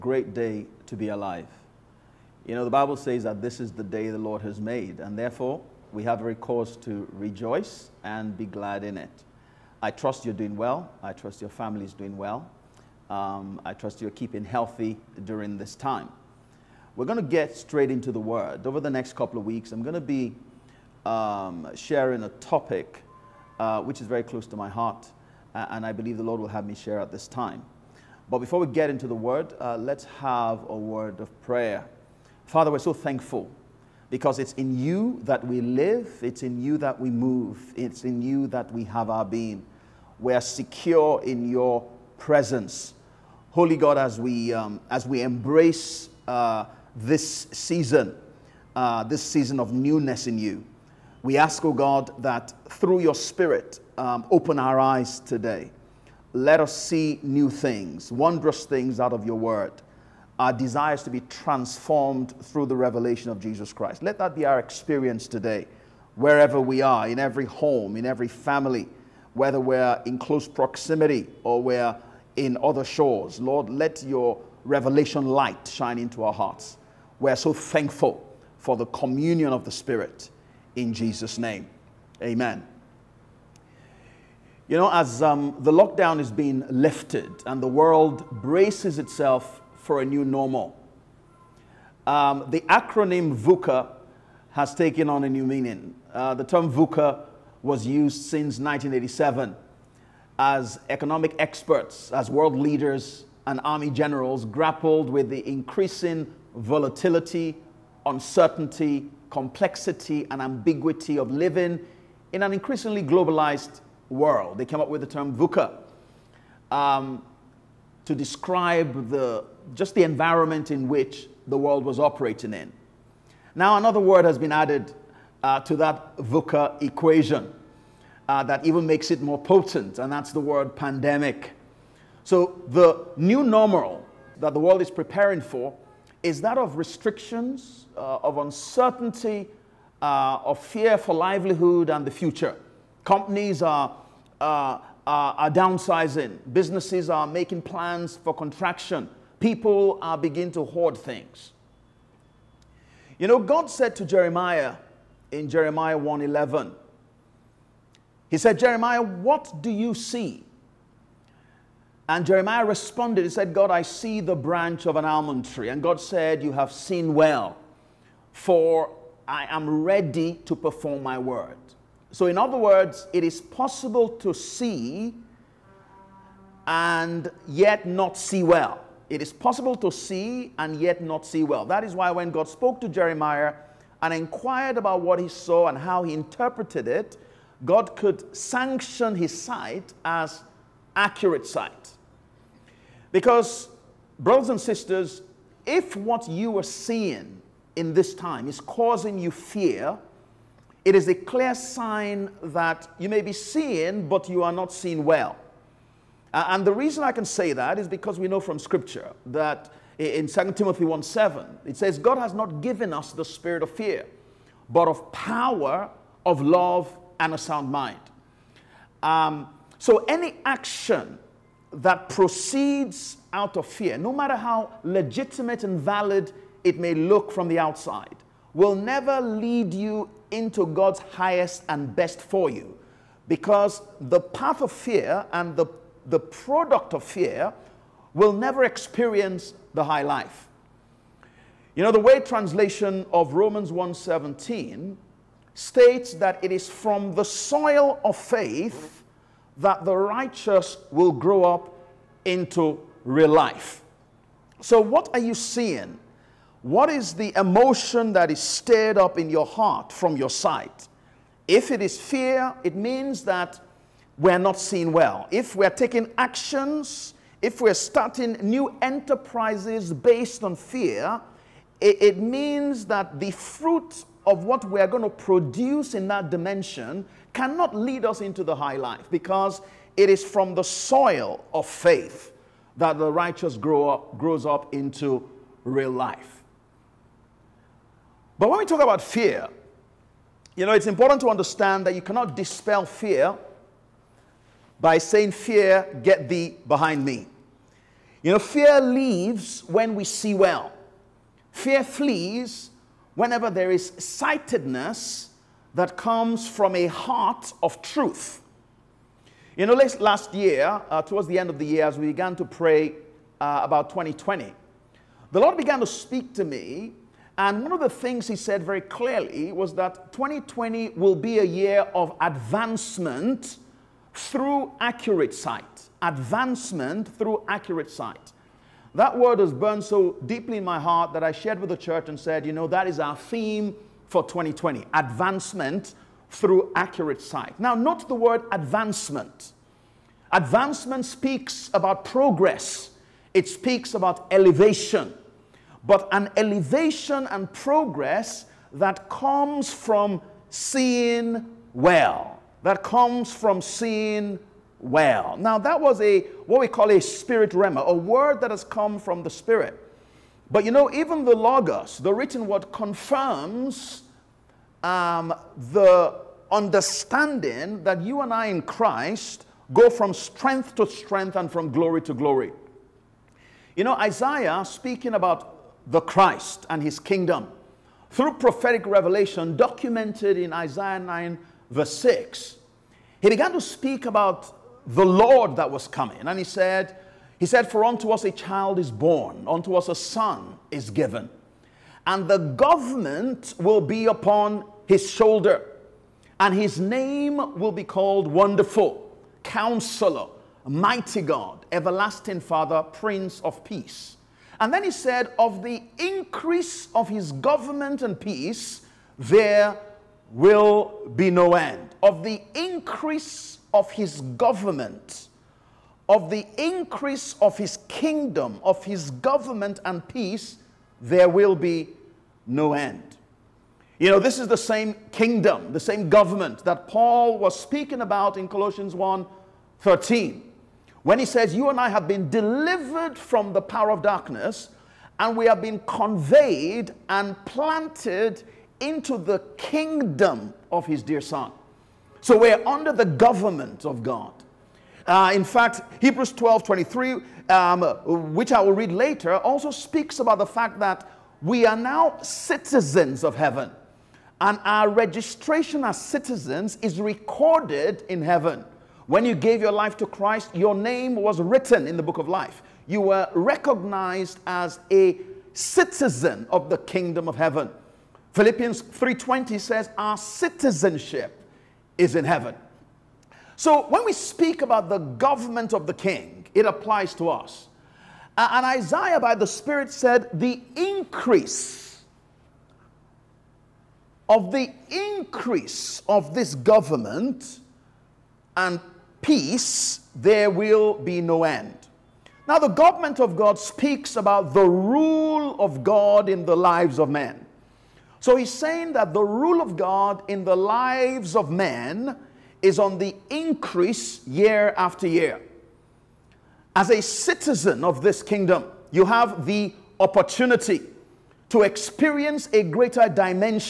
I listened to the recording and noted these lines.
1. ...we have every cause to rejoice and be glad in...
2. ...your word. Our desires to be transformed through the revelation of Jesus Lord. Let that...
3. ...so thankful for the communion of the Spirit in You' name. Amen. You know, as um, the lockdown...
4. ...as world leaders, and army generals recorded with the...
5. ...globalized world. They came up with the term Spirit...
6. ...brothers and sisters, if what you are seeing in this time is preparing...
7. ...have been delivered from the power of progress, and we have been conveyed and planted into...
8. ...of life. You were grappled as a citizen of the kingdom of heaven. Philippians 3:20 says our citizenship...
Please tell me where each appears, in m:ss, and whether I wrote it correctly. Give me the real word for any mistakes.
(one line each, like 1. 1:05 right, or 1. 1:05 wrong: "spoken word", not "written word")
1. 0:05 right
2. 0:59 wrong: "Christ", not "Lord"
3. 1:17 wrong: "Jesus", not "You"
4. 1:42 wrong: "grappled", not "recorded"
5. 1:53 wrong: "VUCA", not "Spirit"
6. 3:14 wrong: "causing", not "preparing"
7. 7:11 wrong: "darkness", not "progress"
8. 7:42 wrong: "recognized", not "grappled".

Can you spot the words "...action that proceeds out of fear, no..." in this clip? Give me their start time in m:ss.
3:40.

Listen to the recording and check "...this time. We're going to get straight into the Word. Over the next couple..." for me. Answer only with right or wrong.
right.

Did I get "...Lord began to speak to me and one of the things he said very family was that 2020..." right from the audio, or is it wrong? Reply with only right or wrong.
wrong.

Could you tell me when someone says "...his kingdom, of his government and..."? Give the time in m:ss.
6:57.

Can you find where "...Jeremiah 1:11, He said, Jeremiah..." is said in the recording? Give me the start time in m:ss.
2:35.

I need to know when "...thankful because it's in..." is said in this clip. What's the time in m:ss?
0:32.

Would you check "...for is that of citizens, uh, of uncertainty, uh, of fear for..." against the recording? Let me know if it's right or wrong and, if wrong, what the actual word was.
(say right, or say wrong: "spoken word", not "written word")
wrong: "restrictions", not "citizens".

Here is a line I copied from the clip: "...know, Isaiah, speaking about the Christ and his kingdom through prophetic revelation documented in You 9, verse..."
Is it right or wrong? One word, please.
wrong.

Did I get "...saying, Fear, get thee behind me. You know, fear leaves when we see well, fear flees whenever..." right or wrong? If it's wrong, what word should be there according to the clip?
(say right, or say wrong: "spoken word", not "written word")
right.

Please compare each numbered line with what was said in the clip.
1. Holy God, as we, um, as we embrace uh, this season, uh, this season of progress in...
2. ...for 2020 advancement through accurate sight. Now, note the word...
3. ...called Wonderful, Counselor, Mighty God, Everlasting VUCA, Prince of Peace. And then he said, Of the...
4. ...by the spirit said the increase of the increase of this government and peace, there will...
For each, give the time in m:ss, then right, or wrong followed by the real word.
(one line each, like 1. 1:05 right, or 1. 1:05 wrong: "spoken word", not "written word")
1. 0:43 wrong: "newness", not "progress"
2. 5:34 right
3. 6:37 wrong: "Father", not "VUCA"
4. 7:59 right.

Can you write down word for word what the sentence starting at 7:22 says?
So we're under the government of God.